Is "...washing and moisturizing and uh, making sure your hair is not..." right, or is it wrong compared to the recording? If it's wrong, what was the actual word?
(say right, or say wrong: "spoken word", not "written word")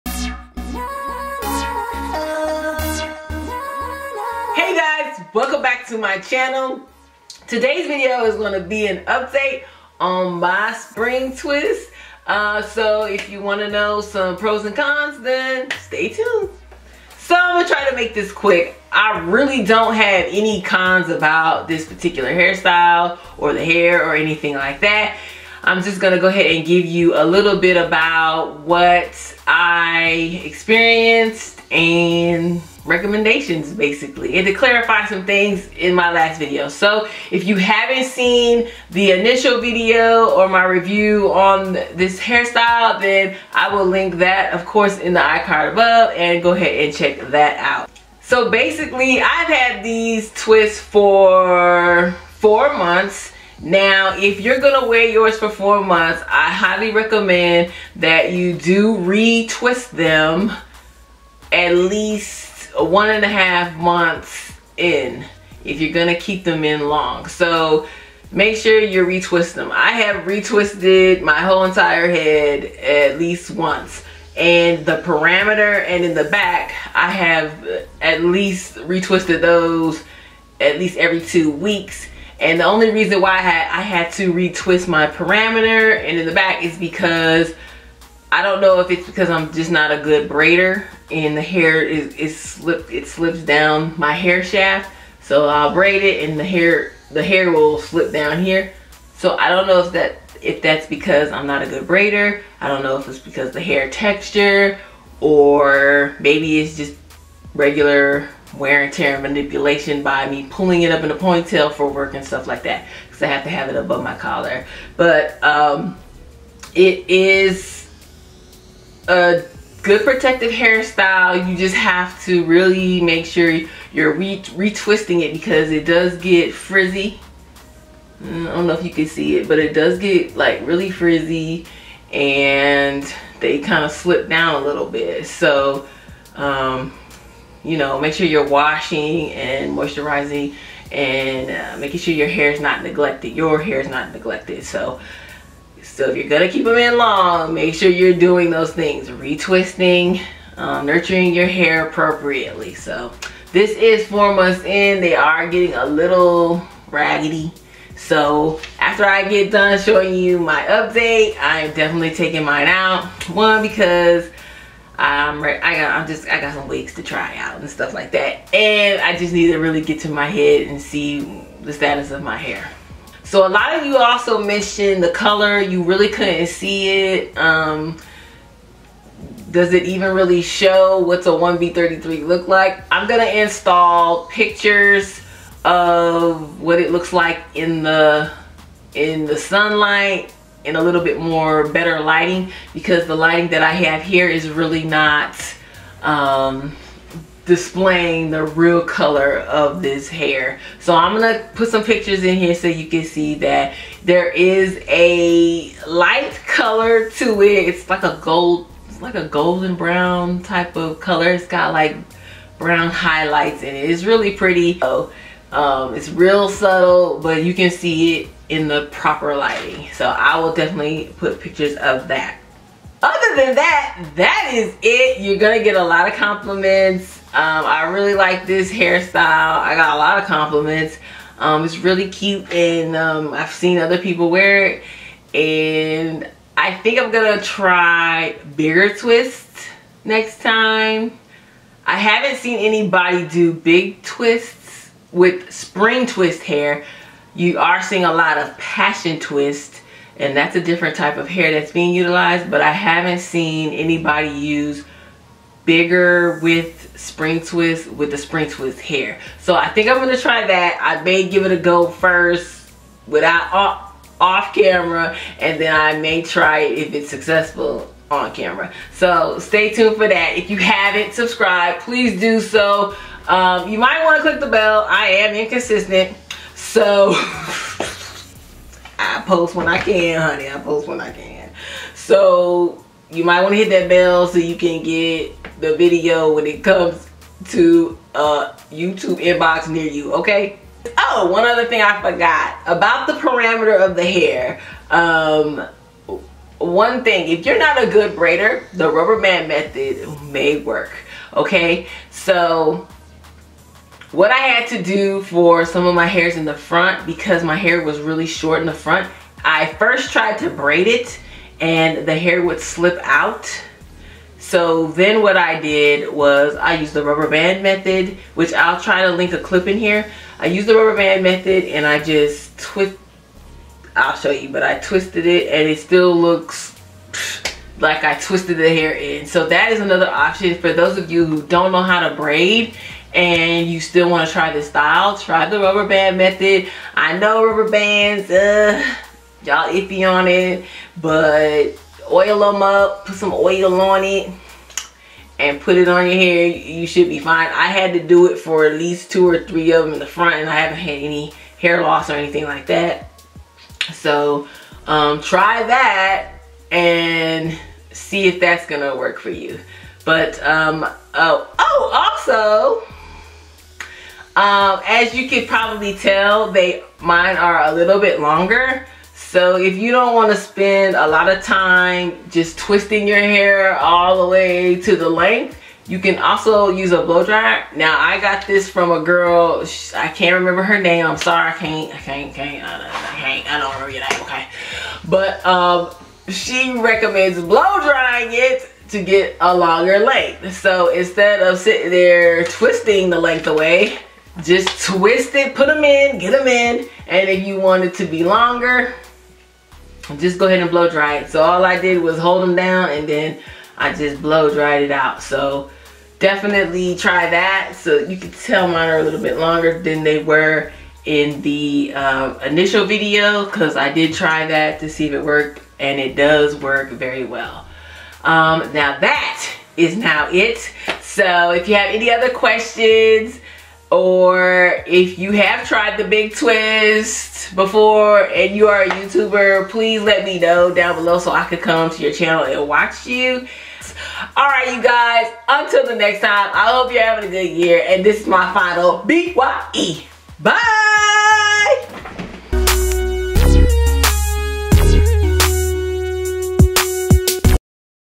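right.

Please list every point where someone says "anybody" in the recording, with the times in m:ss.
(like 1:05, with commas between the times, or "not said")
4:02, 4:13.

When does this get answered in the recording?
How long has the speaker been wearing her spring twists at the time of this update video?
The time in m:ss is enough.
0:52.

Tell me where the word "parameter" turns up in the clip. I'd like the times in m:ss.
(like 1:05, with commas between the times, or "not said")
1:14, 1:25, 4:53.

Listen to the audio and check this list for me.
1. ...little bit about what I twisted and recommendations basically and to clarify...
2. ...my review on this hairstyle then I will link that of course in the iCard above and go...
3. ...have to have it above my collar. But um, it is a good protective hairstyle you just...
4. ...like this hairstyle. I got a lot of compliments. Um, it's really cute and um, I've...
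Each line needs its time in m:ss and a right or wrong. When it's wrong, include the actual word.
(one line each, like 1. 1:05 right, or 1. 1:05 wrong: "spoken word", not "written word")
1. 0:27 wrong: "experienced", not "twisted"
2. 0:40 right
3. 1:53 right
4. 3:48 right.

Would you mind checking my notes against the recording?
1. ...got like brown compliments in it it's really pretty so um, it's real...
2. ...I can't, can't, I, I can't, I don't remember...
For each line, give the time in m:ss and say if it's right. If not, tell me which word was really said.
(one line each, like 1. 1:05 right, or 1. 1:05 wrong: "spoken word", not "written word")
1. 3:31 wrong: "highlights", not "compliments"
2. 6:21 right.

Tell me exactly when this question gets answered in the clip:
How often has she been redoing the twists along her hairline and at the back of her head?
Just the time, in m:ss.
1:20.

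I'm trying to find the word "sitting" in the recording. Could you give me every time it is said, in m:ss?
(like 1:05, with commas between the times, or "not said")
6:31.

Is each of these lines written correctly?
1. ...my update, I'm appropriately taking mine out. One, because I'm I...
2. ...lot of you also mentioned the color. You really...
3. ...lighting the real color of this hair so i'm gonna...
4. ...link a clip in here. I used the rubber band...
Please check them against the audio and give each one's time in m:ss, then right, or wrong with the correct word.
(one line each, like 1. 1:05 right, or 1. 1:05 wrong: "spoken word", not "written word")
1. 2:40 wrong: "definitely", not "appropriately"
2. 2:53 right
3. 3:17 wrong: "displaying", not "lighting"
4. 5:19 right.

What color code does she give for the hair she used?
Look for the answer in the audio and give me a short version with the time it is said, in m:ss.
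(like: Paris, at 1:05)
1B33, at 3:01.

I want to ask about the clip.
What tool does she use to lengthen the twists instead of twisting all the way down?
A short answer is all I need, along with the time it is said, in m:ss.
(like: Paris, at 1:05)
blow dryer, at 6:17.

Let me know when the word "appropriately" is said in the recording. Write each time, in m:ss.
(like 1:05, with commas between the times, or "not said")
2:31.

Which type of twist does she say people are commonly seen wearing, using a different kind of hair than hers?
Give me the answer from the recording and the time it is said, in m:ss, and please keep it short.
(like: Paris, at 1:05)
passion twist, at 4:08.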